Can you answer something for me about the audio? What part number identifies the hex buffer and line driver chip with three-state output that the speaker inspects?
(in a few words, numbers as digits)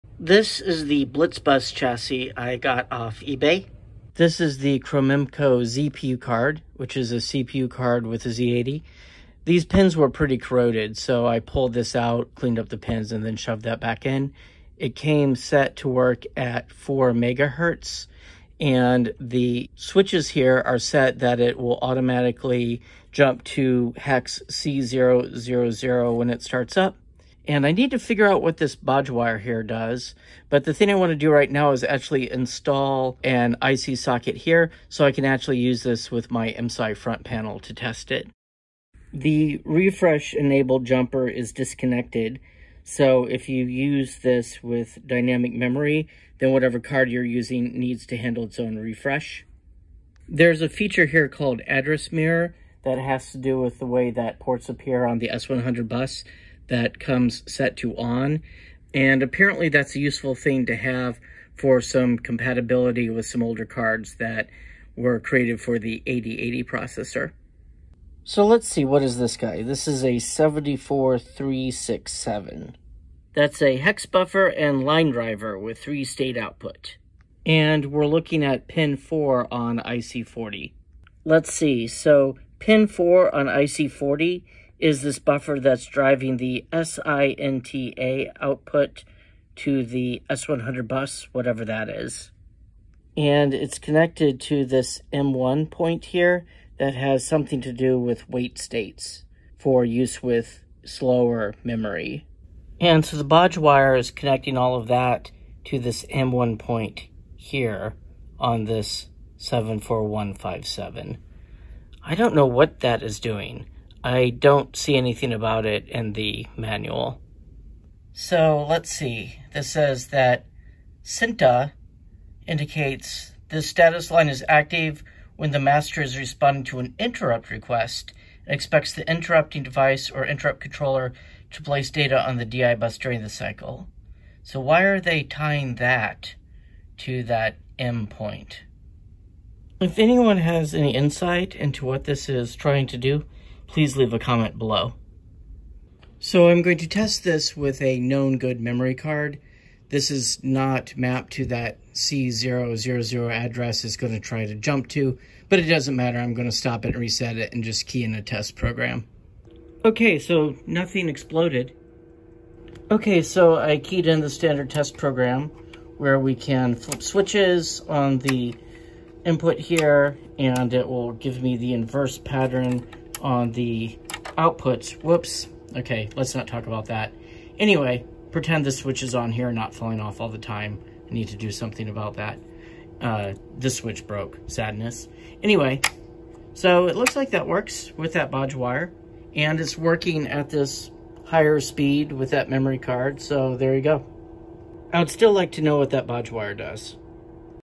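74367.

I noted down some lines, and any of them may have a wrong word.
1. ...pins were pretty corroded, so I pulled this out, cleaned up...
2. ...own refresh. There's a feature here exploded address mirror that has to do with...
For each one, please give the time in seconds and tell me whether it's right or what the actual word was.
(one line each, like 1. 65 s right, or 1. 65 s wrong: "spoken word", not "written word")
1. 9 s right
2. 48 s wrong: "called", not "exploded".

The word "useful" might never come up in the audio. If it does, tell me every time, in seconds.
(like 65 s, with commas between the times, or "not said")
59 s.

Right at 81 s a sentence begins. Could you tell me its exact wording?
Let's see, so pin 4 on IC40 is this buffer that's driving the SINTA output to the S100 bus, whatever that is.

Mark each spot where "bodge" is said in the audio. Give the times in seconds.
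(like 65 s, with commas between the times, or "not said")
28 s, 103 s, 188 s, 196 s.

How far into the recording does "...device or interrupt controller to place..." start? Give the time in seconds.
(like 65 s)
129 s.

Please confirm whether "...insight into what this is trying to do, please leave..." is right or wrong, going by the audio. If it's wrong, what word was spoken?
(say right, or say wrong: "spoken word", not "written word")
right.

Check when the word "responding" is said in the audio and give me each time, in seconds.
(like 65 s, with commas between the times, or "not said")
126 s.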